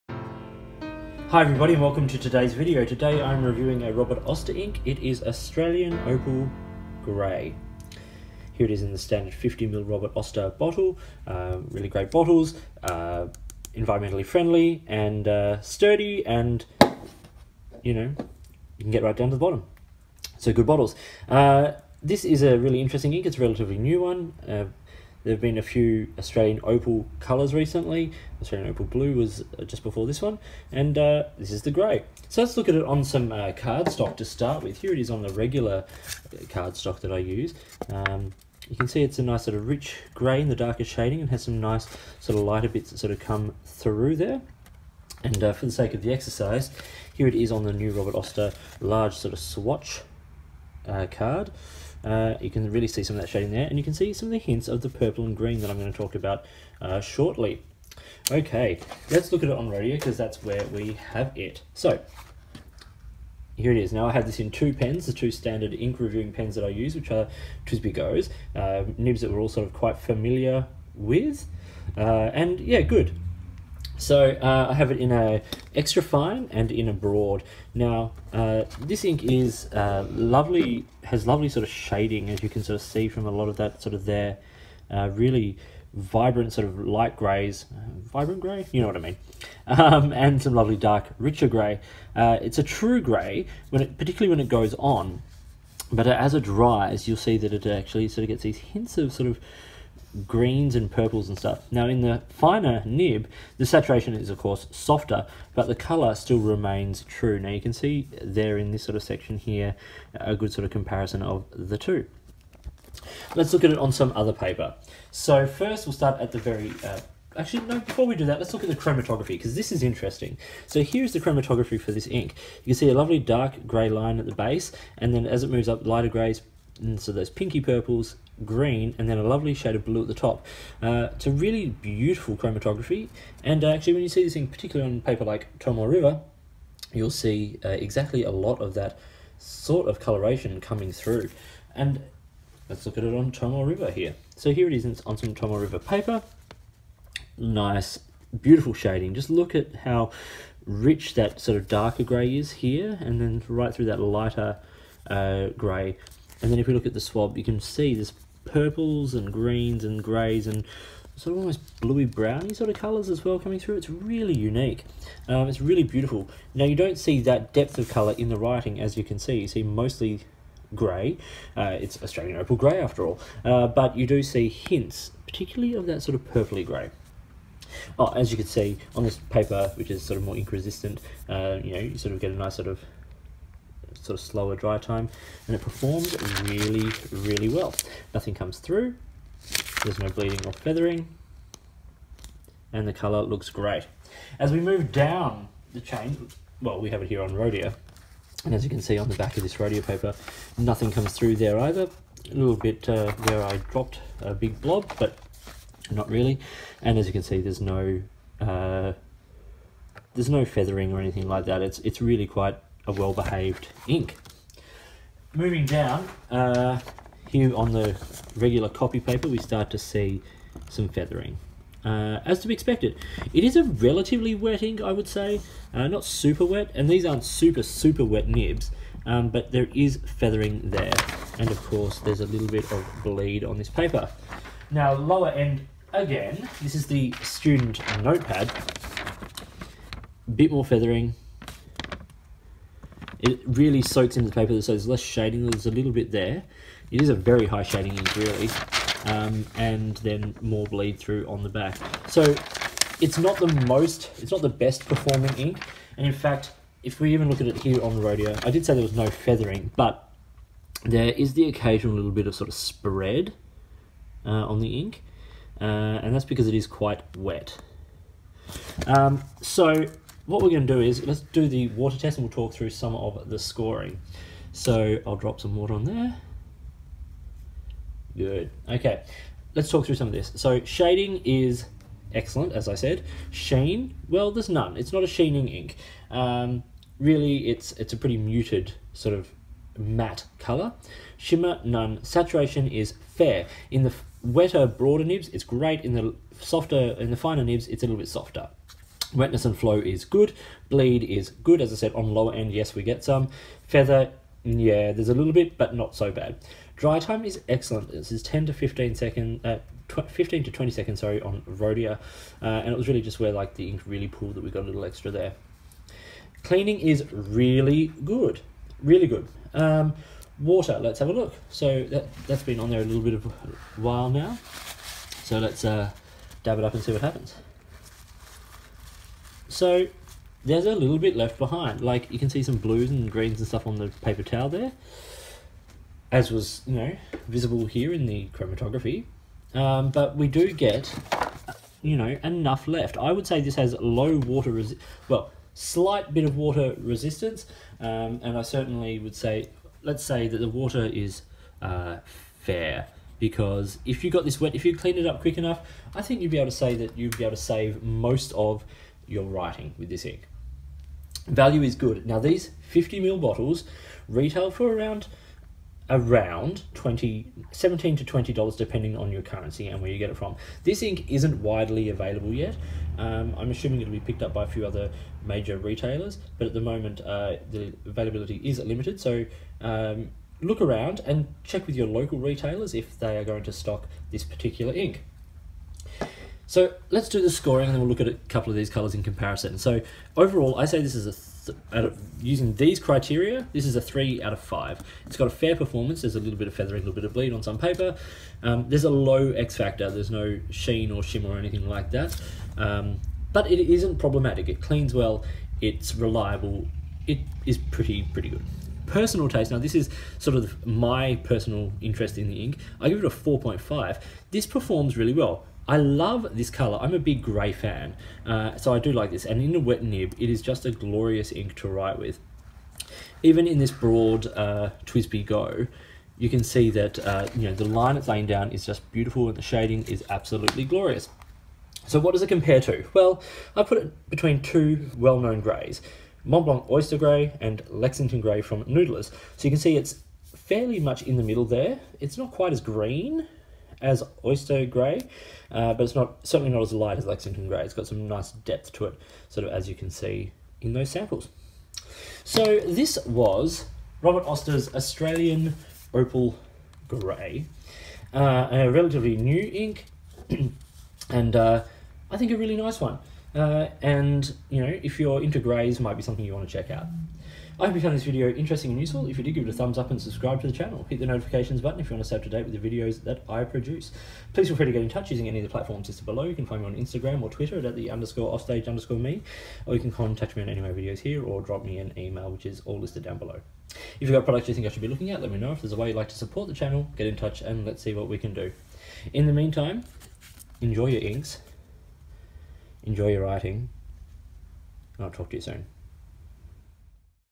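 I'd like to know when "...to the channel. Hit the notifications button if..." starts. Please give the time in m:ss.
7:50.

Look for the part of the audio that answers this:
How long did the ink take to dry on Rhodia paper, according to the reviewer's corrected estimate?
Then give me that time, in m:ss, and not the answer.
5:10.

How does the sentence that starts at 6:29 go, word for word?
So overall, I say this is a th of, using these criteria, this is a three out of five.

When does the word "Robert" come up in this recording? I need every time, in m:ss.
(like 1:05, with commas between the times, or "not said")
0:03, 0:09, 0:47, 7:34.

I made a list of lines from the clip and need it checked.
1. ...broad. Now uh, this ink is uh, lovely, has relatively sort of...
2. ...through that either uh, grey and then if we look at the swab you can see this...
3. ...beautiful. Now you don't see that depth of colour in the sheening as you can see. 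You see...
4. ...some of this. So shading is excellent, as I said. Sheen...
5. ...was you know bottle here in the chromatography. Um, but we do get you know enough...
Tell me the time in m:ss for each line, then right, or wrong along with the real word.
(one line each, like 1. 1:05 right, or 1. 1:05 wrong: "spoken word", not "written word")
1. 1:16 wrong: "lovely", not "relatively"
2. 2:33 wrong: "lighter", not "either"
3. 2:45 wrong: "writing", not "sheening"
4. 4:39 right
5. 5:36 wrong: "visible", not "bottle".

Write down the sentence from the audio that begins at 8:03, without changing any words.
If you've got products you think I should be looking at, let me know.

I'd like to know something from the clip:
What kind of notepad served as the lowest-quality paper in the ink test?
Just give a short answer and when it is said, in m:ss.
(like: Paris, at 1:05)
Student notepad, at 3:56.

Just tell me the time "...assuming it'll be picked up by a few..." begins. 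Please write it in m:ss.
6:13.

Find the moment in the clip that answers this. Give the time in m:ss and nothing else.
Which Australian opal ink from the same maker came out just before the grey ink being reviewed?
0:28.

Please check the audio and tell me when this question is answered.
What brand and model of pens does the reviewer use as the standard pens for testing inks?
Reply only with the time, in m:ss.
1:07.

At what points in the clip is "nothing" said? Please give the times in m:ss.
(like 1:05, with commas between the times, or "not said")
3:08, 3:20.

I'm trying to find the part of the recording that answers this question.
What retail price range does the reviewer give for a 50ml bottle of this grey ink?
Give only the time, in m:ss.
6:07.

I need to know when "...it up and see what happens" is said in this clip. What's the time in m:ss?
5:26.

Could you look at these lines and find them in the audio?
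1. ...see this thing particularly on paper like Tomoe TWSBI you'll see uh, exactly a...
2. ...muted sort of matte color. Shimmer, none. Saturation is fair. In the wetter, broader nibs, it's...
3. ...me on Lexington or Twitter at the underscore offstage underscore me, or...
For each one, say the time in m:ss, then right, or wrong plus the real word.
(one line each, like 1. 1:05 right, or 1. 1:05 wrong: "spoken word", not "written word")
1. 2:14 wrong: "River", not "TWSBI"
2. 4:48 right
3. 7:56 wrong: "Instagram", not "Lexington".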